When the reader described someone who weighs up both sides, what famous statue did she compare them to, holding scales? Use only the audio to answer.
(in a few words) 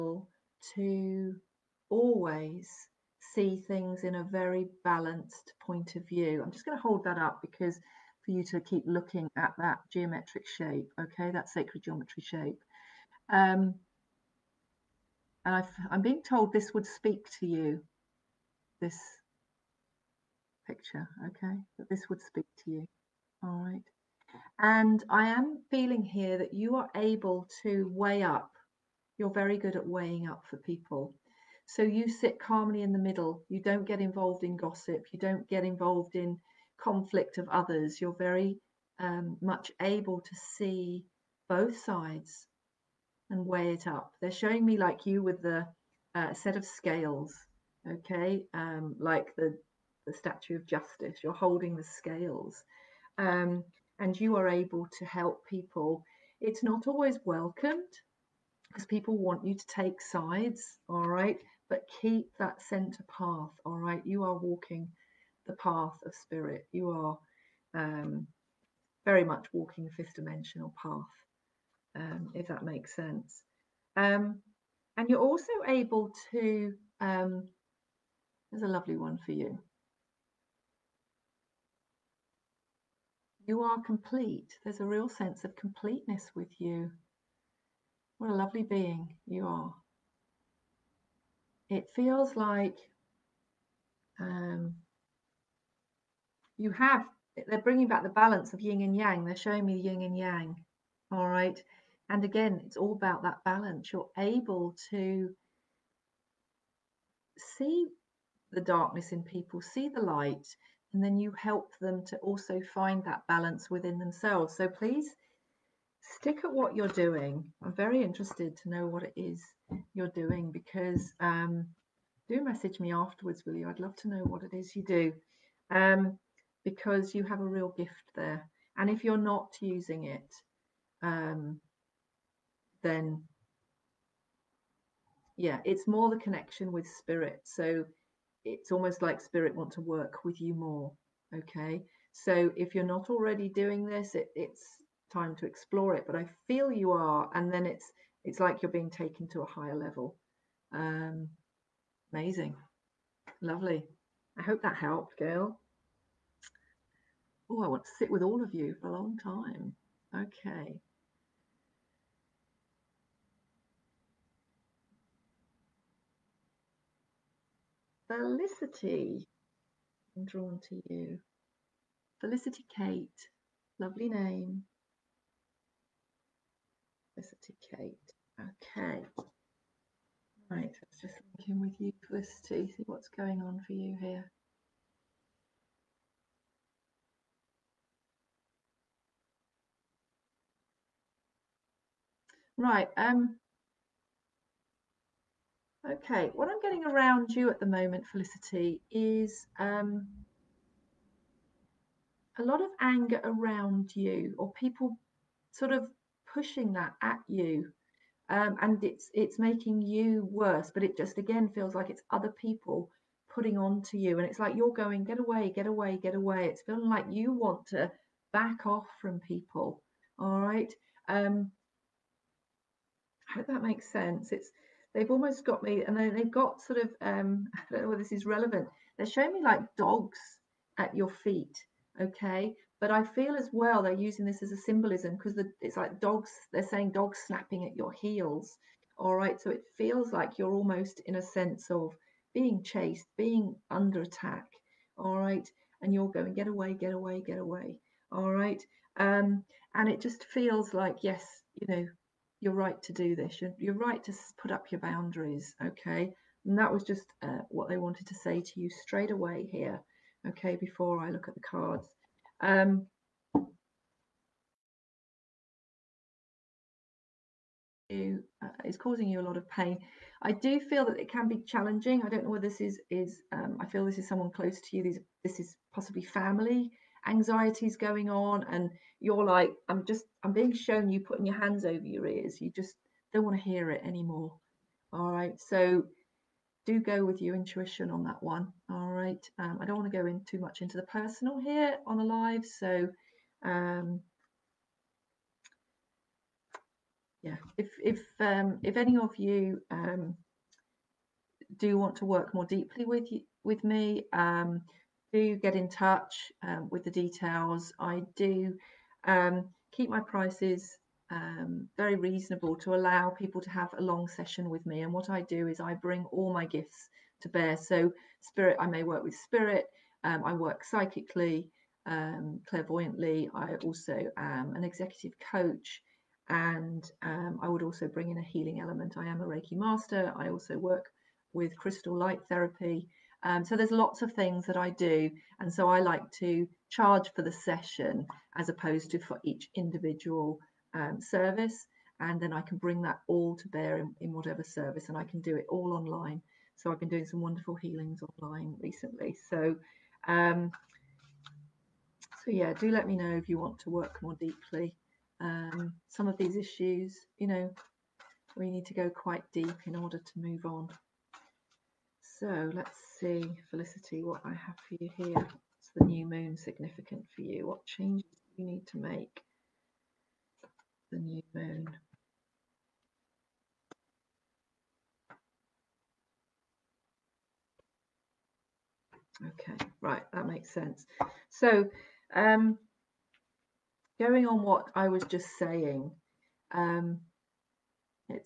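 the statue of justice.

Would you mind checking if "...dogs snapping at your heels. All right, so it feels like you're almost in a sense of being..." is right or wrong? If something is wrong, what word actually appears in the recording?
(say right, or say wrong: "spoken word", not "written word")
right.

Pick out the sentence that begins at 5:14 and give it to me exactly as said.
And what I do is I bring all my gifts to bear.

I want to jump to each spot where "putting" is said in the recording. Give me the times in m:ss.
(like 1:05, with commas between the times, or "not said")
3:33, 4:40.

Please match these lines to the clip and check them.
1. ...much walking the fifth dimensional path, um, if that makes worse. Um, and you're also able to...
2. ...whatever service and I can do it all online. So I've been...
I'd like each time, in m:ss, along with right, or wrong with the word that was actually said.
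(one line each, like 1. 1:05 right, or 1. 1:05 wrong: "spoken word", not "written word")
1. 1:09 wrong: "sense", not "worse"
2. 5:44 right.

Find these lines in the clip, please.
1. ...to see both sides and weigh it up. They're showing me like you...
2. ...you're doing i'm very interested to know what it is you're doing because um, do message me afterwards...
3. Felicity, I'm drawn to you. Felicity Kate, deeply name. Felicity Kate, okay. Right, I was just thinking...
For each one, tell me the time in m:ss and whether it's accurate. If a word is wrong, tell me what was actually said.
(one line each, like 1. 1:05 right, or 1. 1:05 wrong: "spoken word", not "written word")
1. 0:40 right
2. 1:56 right
3. 2:48 wrong: "lovely", not "deeply".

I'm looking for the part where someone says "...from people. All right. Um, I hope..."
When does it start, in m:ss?
3:38.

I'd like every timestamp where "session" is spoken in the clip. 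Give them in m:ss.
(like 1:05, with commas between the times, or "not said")
5:14, 5:37.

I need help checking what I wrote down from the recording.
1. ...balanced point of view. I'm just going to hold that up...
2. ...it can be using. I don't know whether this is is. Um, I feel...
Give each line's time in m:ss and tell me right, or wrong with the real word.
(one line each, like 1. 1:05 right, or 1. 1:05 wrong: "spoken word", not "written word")
1. 0:04 right
2. 4:30 wrong: "challenging", not "using".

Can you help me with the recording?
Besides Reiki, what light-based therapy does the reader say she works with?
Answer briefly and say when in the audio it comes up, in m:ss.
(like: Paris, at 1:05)
crystal light therapy, at 5:31.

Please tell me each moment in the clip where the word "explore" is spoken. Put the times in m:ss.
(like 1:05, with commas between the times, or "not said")
2:25.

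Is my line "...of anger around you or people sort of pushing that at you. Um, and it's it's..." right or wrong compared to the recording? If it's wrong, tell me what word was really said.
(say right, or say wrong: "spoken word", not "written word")
right.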